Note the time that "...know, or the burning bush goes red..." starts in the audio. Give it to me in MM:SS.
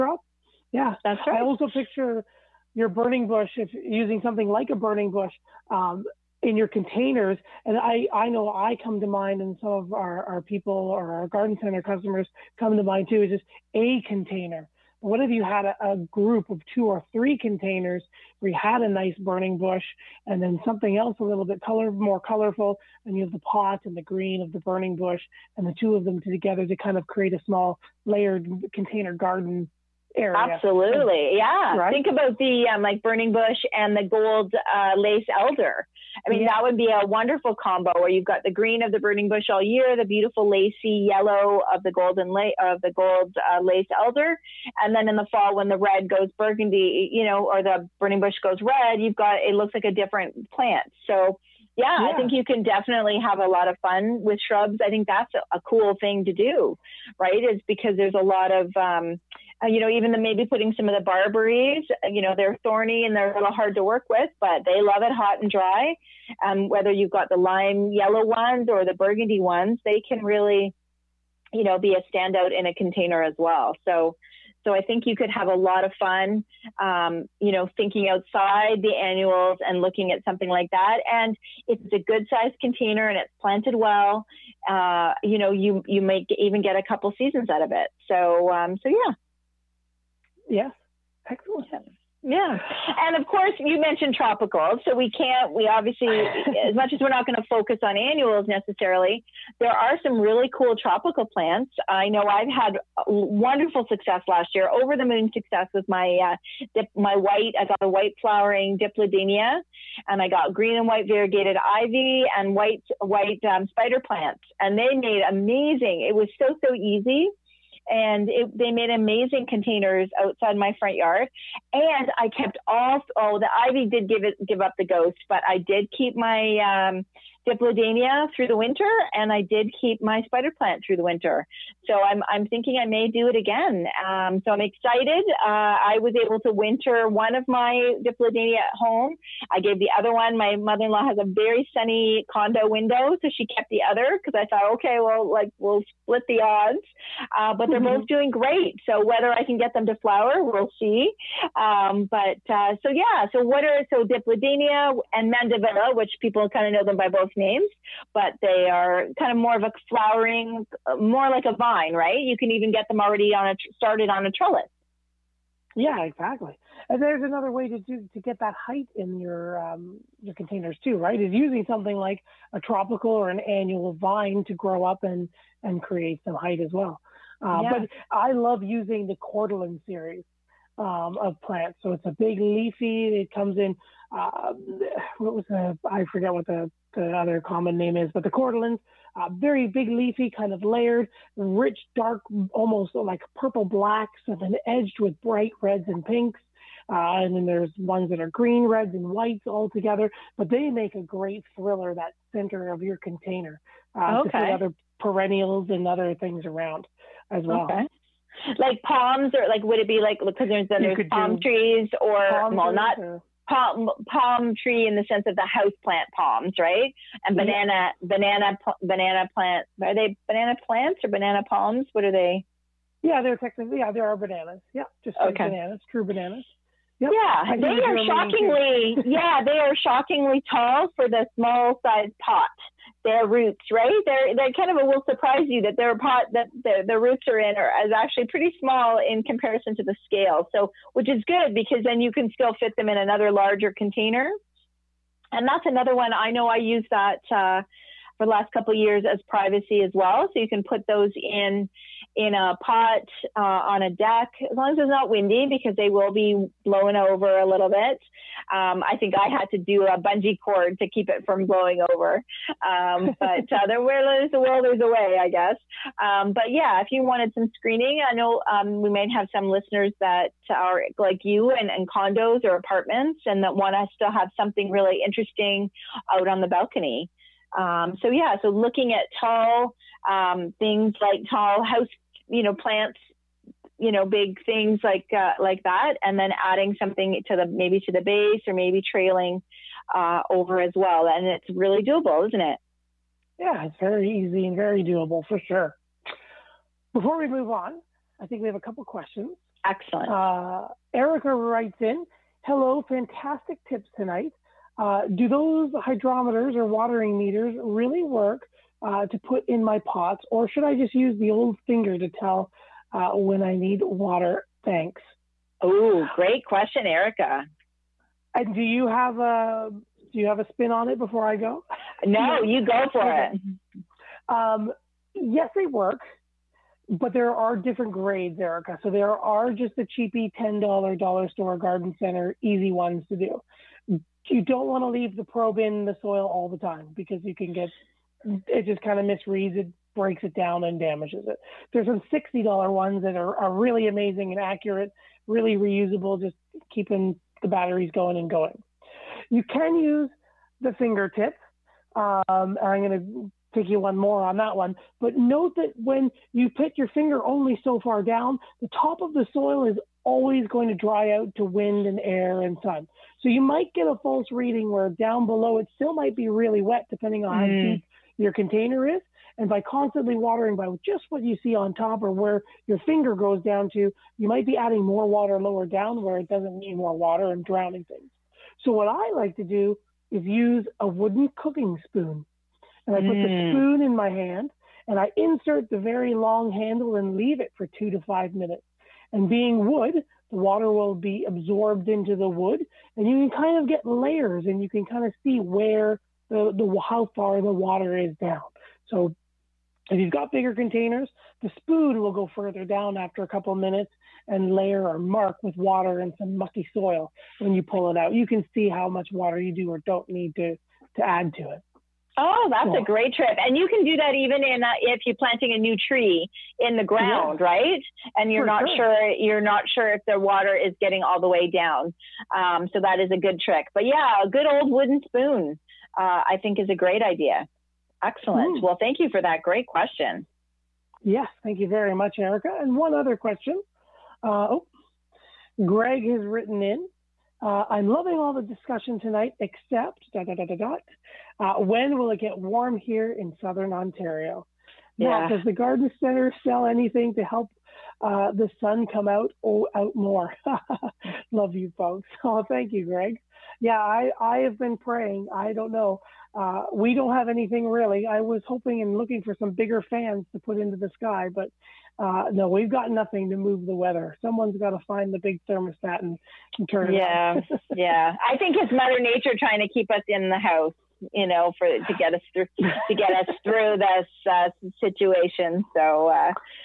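00:47.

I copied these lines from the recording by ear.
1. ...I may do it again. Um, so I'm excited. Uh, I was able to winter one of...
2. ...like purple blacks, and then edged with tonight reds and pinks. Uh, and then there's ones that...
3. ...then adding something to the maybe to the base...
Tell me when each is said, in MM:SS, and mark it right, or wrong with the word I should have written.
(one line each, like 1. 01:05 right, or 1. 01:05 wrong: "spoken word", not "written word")
1. 02:12 right
2. 03:12 wrong: "bright", not "tonight"
3. 04:46 right.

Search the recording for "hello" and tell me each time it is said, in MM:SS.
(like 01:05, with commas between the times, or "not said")
05:02.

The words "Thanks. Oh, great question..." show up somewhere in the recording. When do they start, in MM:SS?
05:14.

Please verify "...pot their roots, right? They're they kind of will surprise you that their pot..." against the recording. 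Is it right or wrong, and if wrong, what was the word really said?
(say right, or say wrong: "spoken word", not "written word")
right.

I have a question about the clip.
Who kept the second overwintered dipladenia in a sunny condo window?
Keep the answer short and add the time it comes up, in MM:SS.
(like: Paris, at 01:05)
Mother-in-law, at 02:20.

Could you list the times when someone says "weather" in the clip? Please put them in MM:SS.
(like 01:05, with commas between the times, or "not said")
07:43.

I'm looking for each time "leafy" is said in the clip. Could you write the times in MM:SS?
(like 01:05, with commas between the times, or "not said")
03:02, 03:09.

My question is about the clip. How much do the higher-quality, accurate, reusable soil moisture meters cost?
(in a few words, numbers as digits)
$60.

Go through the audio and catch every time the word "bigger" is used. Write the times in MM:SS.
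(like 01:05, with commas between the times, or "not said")
06:40, 07:39.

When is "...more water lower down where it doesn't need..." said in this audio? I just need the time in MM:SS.
06:14.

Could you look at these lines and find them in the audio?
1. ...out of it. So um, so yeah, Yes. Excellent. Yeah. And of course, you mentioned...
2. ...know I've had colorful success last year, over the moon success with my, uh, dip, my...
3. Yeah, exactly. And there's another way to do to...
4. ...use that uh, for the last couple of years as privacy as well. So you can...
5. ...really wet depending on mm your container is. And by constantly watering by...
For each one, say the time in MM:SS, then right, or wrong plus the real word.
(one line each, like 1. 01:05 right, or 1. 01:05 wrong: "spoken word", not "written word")
1. 01:27 right
2. 01:42 wrong: "wonderful", not "colorful"
3. 02:45 right
4. 04:06 right
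5. 06:06 right.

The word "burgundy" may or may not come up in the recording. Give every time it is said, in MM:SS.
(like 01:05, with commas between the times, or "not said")
00:46, 01:08.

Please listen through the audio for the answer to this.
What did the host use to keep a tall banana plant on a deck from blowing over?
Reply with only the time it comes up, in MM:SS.
04:19.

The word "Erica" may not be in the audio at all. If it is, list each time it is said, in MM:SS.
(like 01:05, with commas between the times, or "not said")
05:00, 05:16, 05:28, 07:12.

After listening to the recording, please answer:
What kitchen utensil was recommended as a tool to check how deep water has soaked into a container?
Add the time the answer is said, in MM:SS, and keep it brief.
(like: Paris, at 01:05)
Wooden cooking spoon, at 06:20.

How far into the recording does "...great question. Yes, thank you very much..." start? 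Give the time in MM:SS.
07:09.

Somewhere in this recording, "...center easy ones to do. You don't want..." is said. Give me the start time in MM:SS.
05:31.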